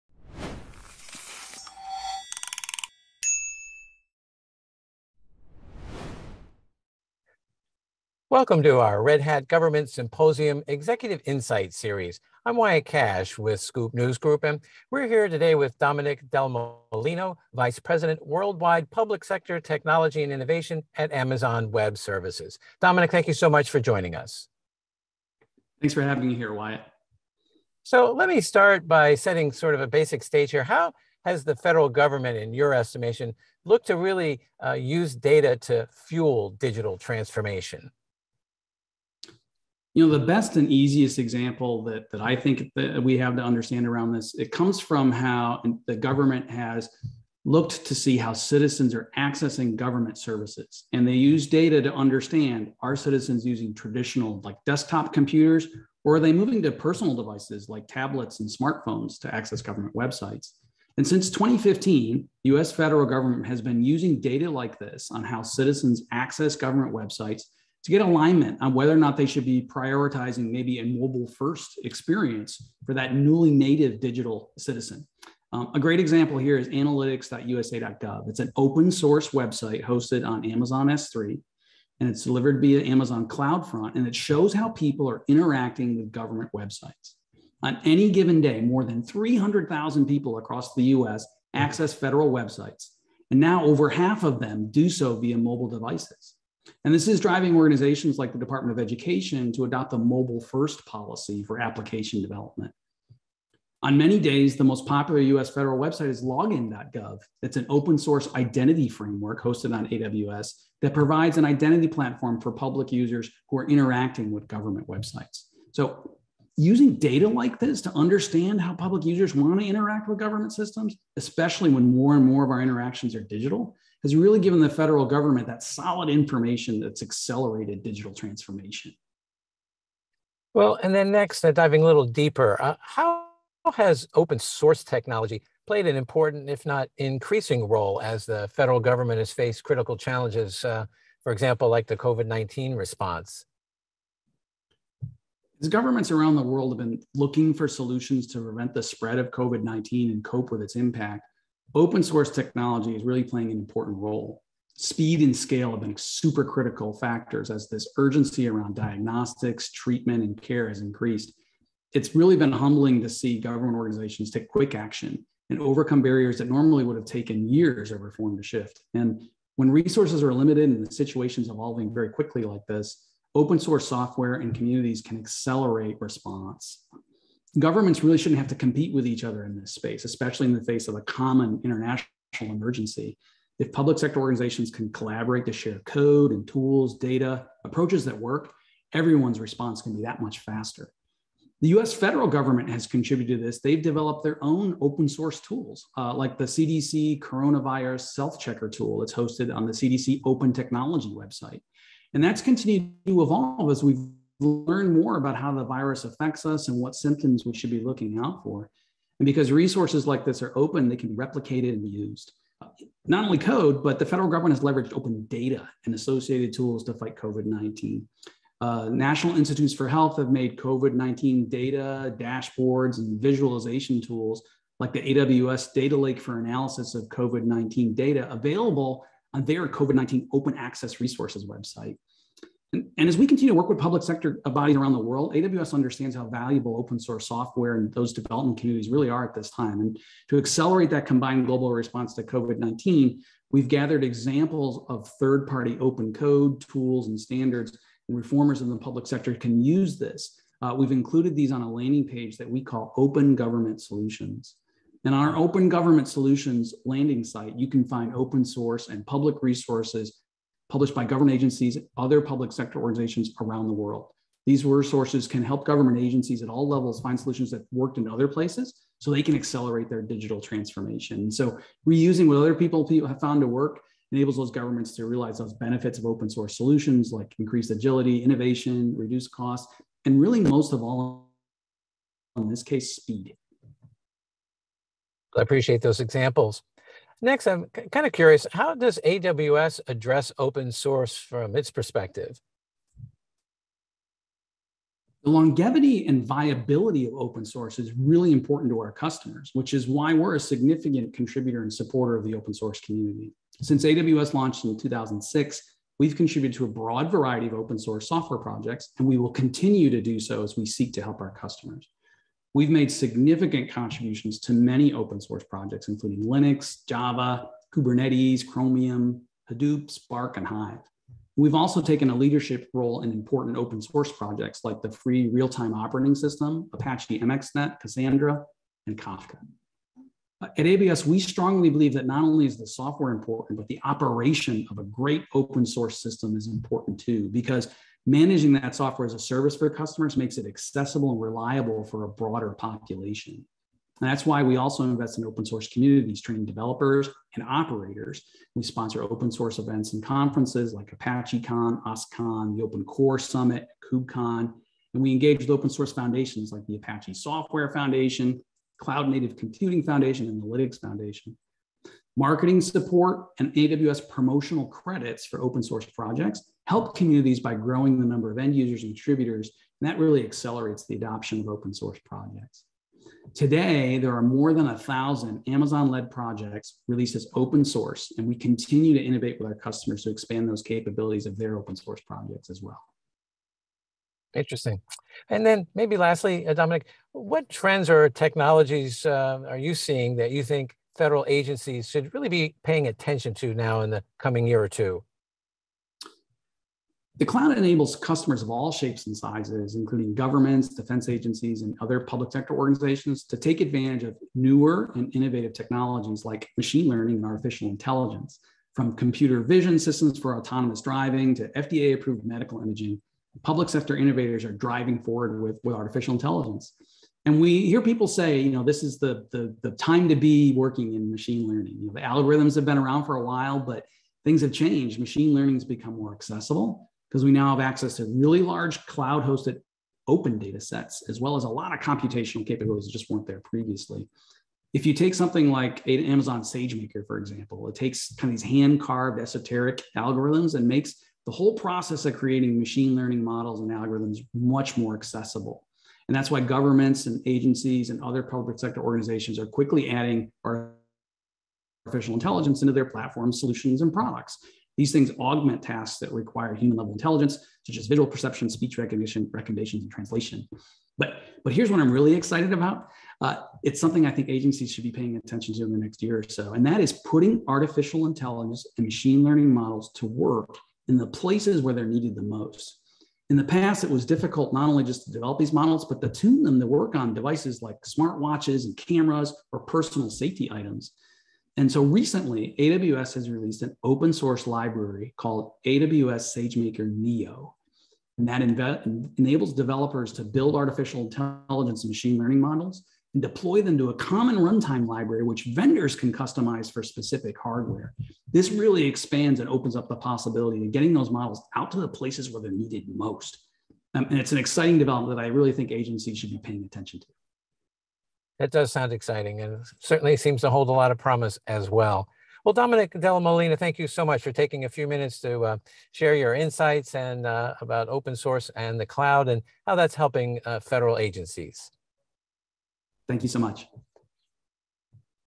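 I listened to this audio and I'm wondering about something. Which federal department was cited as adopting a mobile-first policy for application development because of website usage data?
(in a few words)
Department of Education.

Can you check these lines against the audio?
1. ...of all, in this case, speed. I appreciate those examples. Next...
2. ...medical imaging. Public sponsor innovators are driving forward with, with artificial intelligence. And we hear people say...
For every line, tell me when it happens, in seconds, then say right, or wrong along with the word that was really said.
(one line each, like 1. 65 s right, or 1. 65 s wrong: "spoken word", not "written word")
1. 280 s right
2. 412 s wrong: "sector", not "sponsor".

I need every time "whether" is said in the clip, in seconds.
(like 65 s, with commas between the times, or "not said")
68 s.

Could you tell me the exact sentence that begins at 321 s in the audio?
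We've also taken a leadership role in important open source projects like the free real-time operating system, Apache MXNet, Cassandra, and Kafka.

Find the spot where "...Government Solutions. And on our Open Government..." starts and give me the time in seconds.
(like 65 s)
253 s.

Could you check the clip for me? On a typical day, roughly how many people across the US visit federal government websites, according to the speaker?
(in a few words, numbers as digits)
300,000.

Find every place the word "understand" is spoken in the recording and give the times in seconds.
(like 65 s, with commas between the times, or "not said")
43 s, 51 s, 117 s, 235 s.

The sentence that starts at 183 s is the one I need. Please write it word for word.
If public sector organizations can collaborate to share code and tools, data, approaches that work, everyone's response can be that much faster.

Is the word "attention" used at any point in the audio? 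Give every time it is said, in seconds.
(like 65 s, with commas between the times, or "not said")
392 s, 465 s, 506 s.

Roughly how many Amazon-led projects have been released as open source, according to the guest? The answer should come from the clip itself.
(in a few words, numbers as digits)
more than 1,000.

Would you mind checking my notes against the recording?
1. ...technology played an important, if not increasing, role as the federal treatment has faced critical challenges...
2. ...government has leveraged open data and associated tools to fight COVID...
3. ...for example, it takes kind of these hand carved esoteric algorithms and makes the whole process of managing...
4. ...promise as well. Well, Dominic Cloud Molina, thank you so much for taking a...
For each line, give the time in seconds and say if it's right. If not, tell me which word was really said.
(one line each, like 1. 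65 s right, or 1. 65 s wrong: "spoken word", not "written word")
1. 134 s wrong: "government", not "treatment"
2. 214 s right
3. 437 s wrong: "creating", not "managing"
4. 510 s wrong: "Della", not "Cloud".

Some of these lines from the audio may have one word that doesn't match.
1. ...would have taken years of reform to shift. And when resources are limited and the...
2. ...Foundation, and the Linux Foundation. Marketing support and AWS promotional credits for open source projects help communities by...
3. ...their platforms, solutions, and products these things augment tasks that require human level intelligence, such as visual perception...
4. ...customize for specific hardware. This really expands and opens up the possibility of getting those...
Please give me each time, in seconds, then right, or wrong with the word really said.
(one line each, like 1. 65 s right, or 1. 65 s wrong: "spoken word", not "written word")
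1. 166 s right
2. 359 s right
3. 452 s right
4. 496 s right.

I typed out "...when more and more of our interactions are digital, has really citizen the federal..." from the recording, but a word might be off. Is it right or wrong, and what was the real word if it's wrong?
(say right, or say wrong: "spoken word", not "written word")
wrong: "given", not "citizen".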